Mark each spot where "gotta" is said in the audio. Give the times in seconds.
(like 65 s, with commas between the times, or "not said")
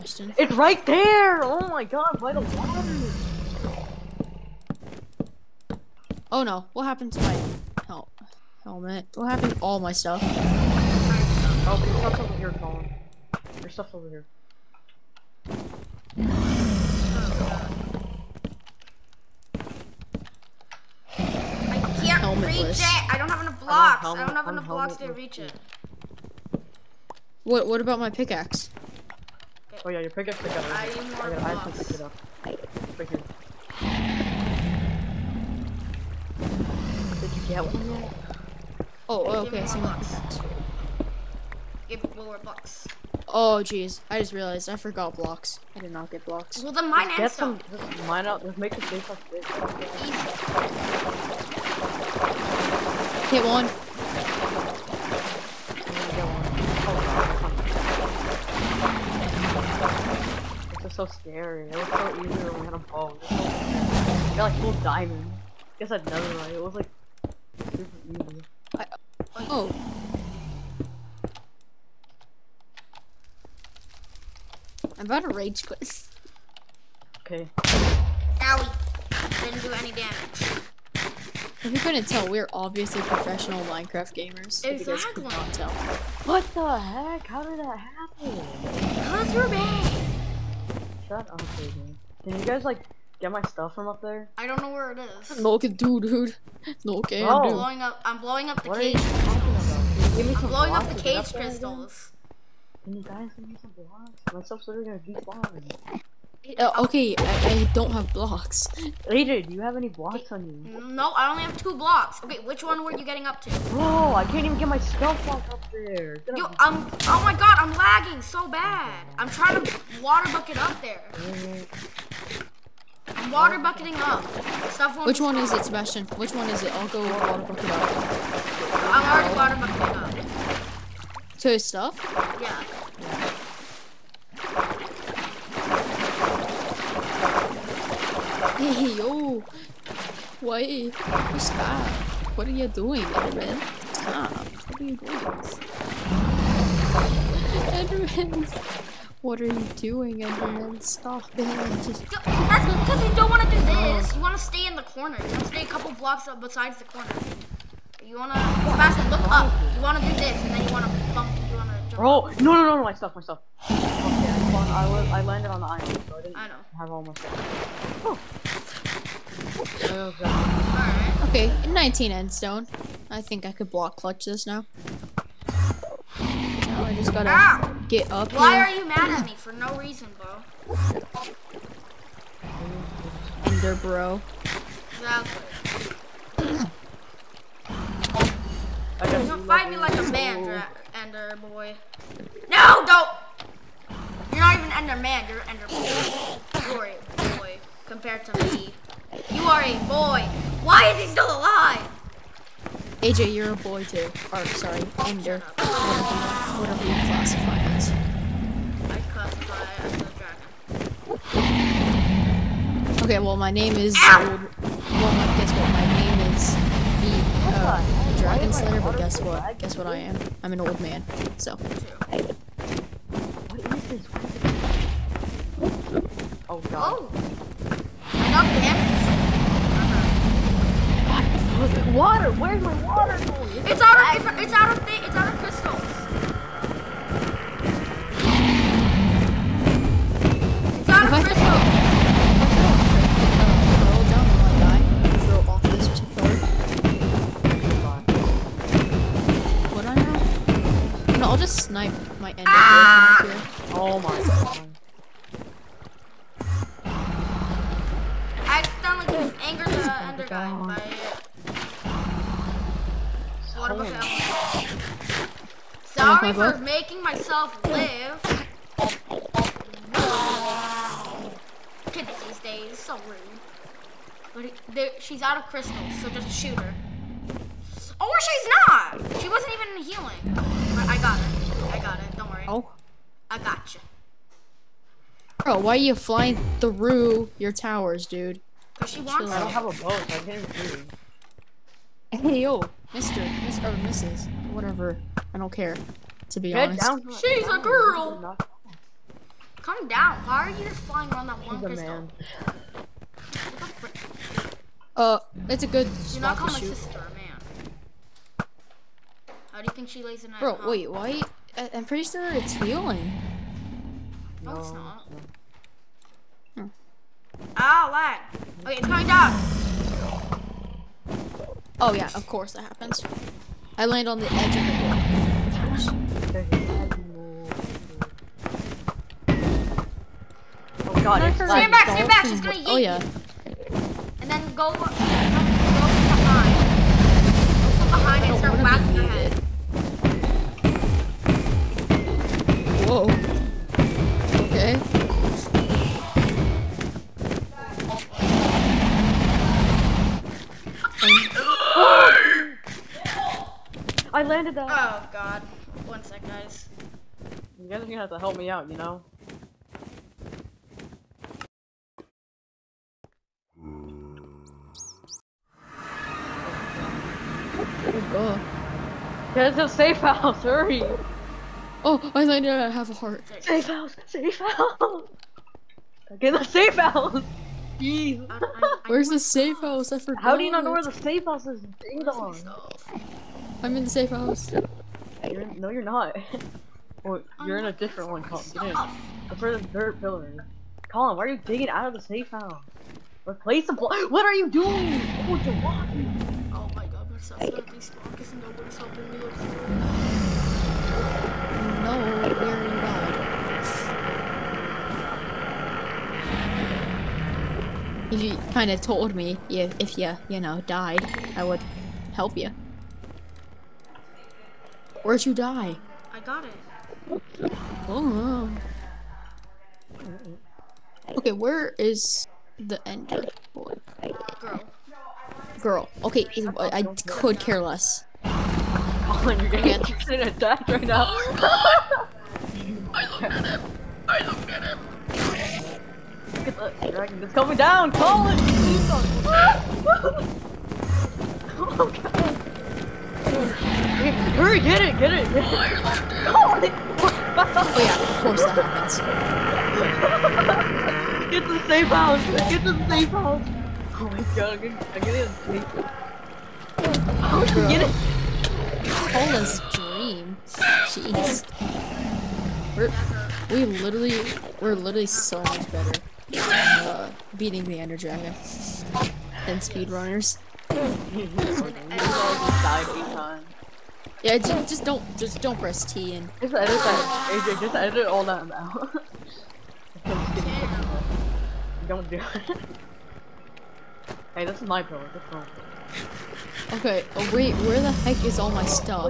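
177 s.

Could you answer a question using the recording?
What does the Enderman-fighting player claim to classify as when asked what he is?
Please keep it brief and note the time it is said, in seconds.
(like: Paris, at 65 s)
a dragon, at 209 s.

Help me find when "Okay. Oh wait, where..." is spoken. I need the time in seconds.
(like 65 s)
486 s.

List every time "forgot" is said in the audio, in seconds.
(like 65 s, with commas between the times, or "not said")
44 s, 379 s.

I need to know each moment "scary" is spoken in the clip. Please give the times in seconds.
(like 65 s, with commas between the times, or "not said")
61 s.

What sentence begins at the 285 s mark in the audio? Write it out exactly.
Bro, why are you flying through your towers, dude?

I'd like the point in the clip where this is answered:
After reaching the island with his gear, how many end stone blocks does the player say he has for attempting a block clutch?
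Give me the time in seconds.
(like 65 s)
171 s.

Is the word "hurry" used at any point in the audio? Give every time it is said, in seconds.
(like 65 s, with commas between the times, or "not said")
370 s, 443 s.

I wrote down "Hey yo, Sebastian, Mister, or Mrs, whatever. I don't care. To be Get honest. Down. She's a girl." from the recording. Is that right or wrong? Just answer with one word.
wrong.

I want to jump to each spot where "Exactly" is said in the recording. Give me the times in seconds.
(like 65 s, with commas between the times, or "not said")
84 s, 184 s.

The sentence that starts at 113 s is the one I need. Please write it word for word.
Bro, I can't even get my stealth block up there.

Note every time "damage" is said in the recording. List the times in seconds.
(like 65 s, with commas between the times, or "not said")
79 s, 228 s.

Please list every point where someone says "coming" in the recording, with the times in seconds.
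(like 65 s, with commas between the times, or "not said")
318 s, 437 s.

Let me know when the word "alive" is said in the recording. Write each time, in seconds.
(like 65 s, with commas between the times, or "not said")
201 s.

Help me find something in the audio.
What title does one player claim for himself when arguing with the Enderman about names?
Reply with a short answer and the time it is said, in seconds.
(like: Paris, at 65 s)
Dragon Slayer, at 218 s.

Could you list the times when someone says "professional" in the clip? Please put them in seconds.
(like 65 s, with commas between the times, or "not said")
83 s.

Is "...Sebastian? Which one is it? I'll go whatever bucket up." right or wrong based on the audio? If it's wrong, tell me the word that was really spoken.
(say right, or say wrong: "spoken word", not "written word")
wrong: "water", not "whatever".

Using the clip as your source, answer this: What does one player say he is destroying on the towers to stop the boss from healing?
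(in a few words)
cage crystals.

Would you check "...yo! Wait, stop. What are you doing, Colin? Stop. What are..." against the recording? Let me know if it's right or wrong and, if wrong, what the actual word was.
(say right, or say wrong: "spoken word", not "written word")
wrong: "Edmund", not "Colin".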